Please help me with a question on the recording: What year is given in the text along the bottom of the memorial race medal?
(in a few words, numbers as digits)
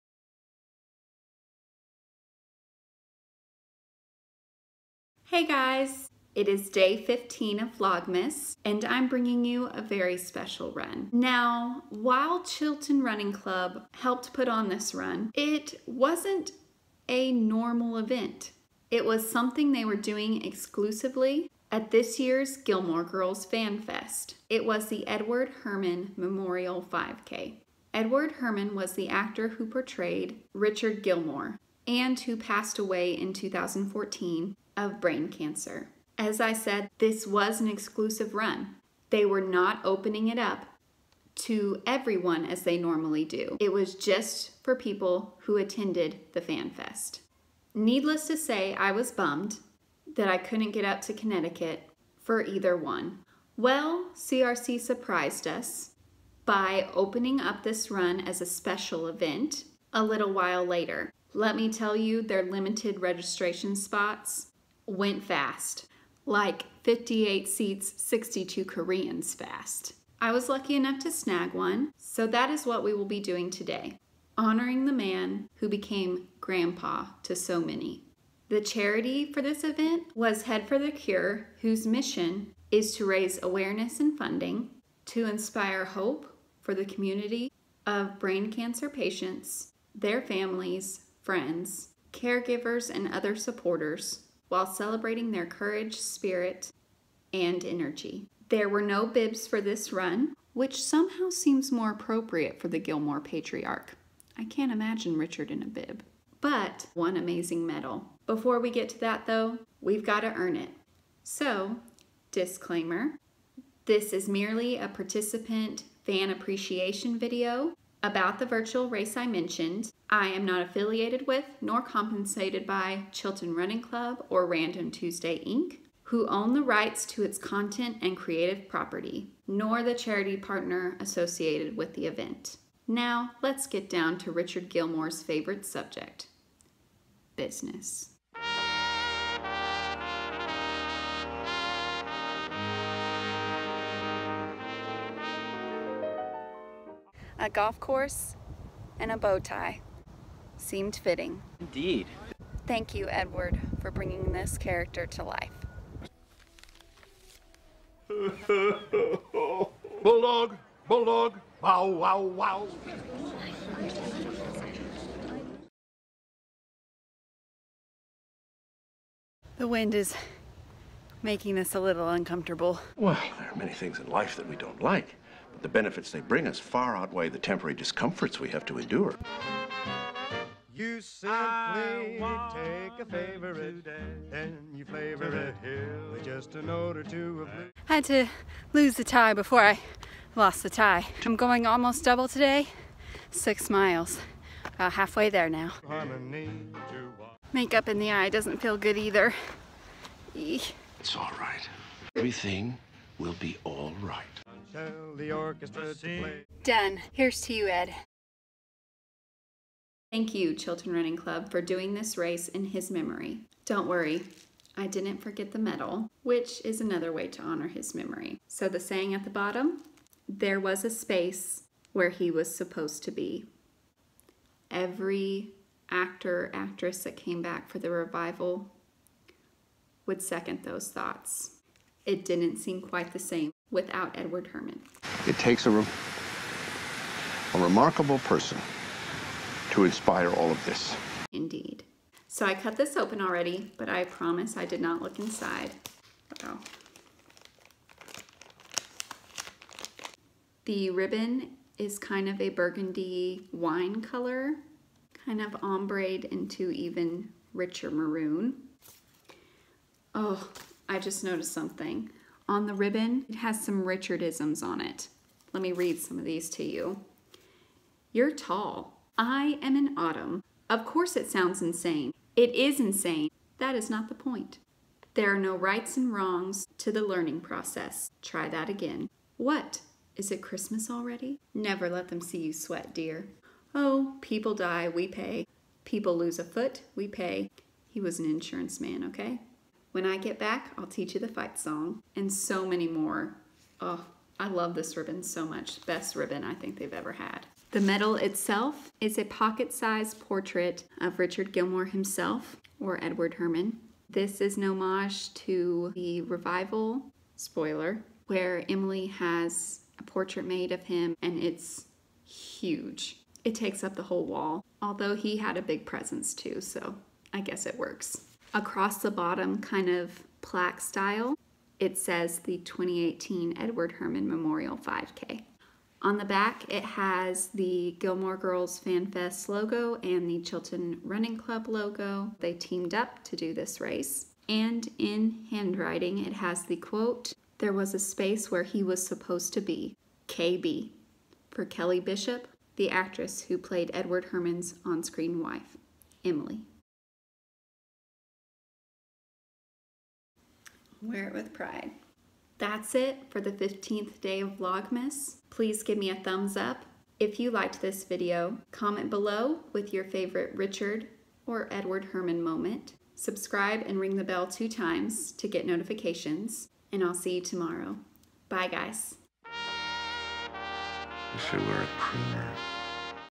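2018.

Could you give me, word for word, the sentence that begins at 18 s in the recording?
It was something they were doing exclusively at this year's Gilmore Girls Fan Fest.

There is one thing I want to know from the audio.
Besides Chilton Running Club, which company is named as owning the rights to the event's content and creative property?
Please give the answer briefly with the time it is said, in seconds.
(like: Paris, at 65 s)
Random Tuesday Inc., at 124 s.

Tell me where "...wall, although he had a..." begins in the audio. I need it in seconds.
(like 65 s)
314 s.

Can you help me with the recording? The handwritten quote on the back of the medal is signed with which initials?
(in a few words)
KB.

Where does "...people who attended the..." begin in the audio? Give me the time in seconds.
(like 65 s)
44 s.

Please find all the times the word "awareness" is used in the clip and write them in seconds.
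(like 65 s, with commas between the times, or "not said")
83 s.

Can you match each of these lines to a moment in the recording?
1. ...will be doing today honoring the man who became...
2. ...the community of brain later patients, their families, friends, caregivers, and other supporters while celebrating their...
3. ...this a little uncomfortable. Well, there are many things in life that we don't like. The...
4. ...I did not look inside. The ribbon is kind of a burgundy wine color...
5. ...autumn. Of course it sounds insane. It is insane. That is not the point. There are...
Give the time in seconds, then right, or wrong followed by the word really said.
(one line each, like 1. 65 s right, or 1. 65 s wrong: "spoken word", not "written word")
1. 72 s right
2. 86 s wrong: "cancer", not "later"
3. 171 s right
4. 244 s right
5. 269 s right.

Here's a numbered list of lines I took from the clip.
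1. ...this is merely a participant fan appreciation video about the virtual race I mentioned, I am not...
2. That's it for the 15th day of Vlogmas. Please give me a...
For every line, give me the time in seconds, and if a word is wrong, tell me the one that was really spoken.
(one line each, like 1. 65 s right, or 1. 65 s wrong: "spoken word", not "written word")
1. 113 s right
2. 352 s right.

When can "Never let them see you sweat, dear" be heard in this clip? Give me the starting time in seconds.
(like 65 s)
281 s.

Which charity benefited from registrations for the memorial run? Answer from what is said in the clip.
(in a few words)
Head for the Cure.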